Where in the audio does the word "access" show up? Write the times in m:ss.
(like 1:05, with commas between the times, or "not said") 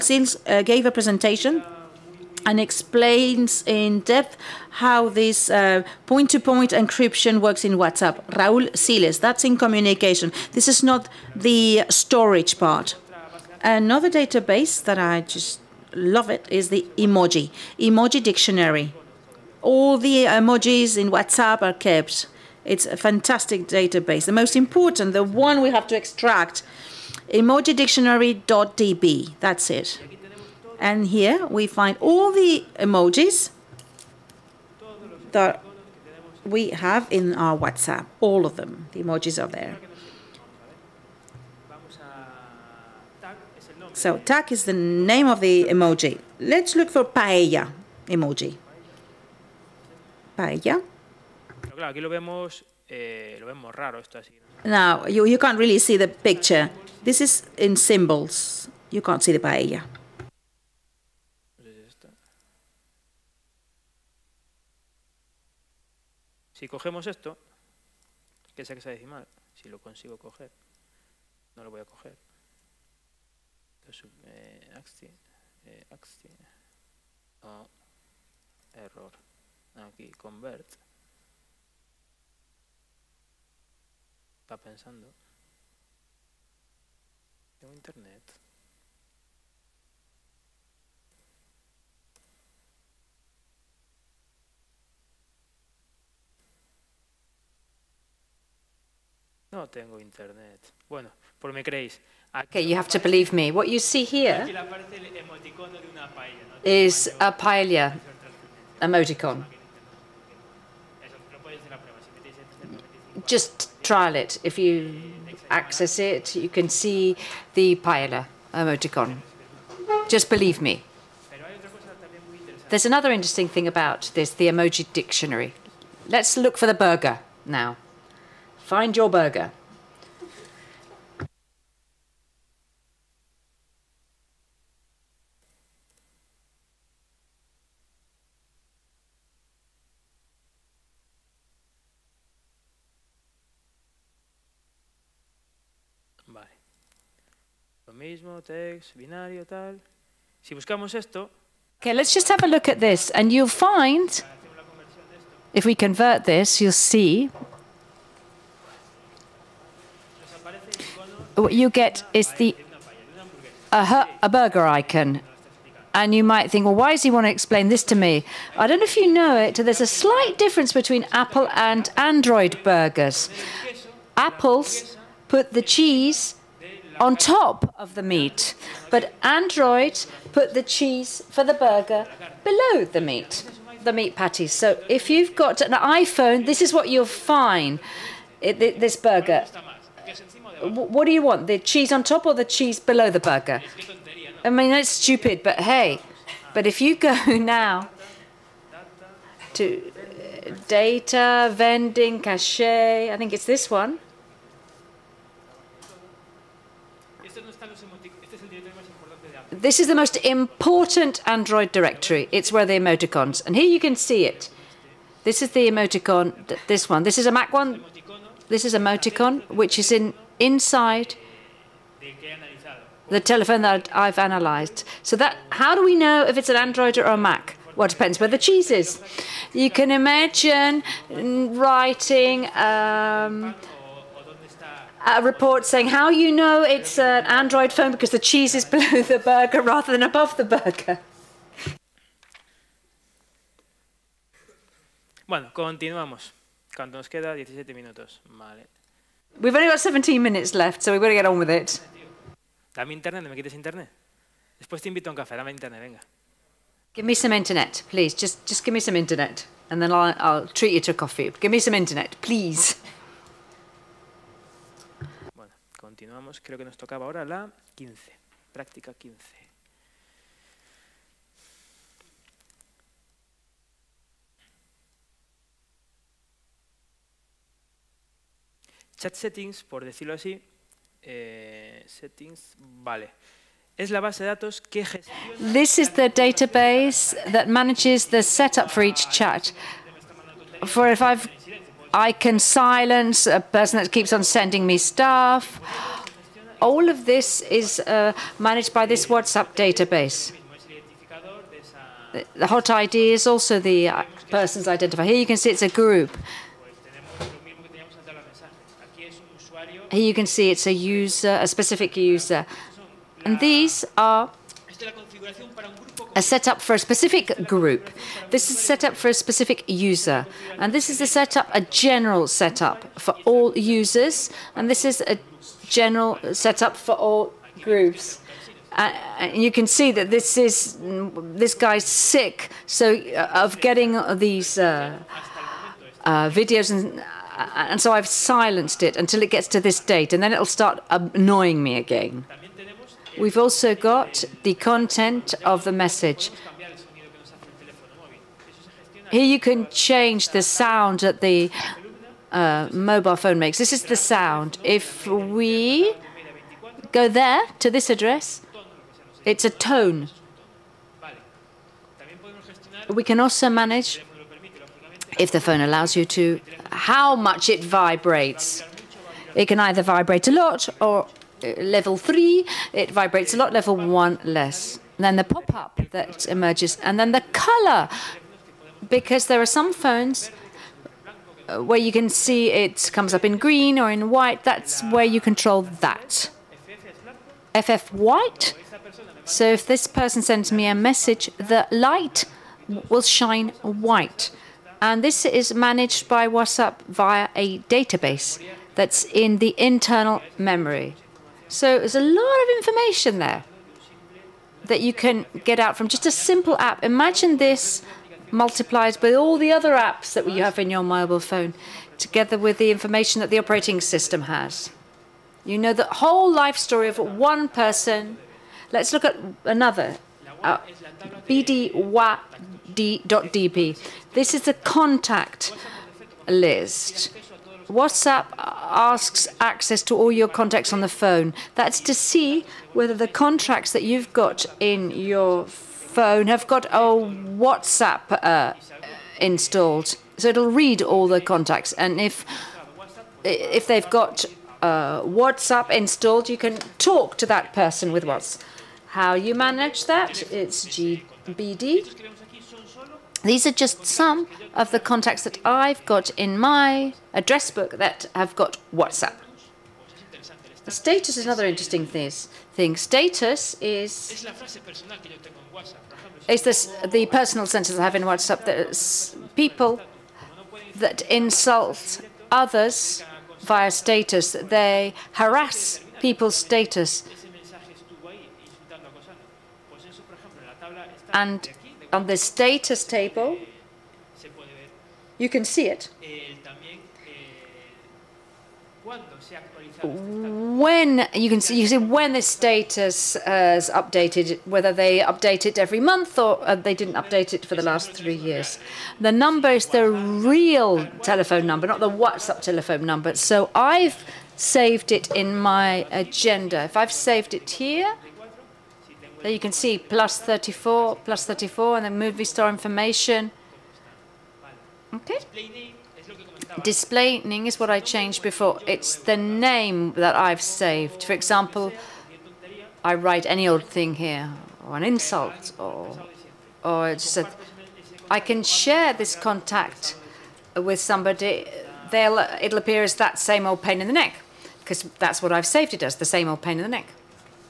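1:55, 7:09.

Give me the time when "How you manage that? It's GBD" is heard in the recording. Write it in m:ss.
7:28.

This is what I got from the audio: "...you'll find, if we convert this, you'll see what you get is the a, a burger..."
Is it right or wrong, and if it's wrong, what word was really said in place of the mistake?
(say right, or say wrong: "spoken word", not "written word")
right.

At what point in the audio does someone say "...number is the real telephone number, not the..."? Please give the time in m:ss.
8:19.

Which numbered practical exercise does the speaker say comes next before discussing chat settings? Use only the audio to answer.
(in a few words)
15.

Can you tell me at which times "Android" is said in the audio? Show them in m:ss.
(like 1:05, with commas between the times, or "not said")
2:51, 2:59, 3:31, 3:46, 3:57.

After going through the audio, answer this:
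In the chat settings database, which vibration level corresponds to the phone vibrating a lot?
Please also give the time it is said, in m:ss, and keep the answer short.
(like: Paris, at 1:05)
level three, at 6:11.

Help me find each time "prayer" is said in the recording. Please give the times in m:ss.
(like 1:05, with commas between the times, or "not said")
not said.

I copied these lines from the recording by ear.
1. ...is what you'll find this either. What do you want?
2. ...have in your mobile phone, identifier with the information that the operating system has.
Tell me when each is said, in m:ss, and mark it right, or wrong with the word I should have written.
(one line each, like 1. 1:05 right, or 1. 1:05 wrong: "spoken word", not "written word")
1. 3:06 wrong: "burger", not "either"
2. 6:50 wrong: "together", not "identifier".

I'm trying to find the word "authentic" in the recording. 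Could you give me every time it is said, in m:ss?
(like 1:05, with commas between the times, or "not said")
not said.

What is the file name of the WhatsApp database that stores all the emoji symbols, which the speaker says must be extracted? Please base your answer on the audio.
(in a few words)
emojidictionary.db.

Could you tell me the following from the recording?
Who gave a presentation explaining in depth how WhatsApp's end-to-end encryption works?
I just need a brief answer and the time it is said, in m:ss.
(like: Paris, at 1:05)
Raul Siles, at 0:08.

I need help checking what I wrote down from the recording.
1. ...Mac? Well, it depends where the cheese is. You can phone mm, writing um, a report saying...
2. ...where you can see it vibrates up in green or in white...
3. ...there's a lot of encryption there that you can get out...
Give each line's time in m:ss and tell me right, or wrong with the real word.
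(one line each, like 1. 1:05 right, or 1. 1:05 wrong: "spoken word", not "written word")
1. 3:47 wrong: "imagine", not "phone"
2. 6:21 wrong: "comes", not "vibrates"
3. 6:41 wrong: "information", not "encryption".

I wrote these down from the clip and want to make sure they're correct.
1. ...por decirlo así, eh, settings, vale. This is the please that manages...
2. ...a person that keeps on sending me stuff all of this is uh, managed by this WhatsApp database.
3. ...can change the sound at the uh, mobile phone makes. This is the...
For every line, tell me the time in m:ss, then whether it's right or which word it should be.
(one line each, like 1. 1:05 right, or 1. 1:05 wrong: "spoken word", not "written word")
1. 4:39 wrong: "database", not "please"
2. 4:53 right
3. 5:49 right.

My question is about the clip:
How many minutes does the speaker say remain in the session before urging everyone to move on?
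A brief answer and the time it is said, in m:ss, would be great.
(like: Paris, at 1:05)
17, at 4:07.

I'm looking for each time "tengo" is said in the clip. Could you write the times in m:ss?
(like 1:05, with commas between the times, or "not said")
1:27, 1:39.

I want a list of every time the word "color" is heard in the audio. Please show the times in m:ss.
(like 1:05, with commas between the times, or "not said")
6:17.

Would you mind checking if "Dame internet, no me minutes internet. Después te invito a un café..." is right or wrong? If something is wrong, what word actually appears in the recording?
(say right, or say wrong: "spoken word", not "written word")
wrong: "quites", not "minutes".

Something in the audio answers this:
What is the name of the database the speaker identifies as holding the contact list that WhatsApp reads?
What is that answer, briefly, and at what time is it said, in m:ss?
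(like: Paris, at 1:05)
bdwad.db, at 7:01.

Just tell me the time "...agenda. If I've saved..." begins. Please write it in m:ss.
8:25.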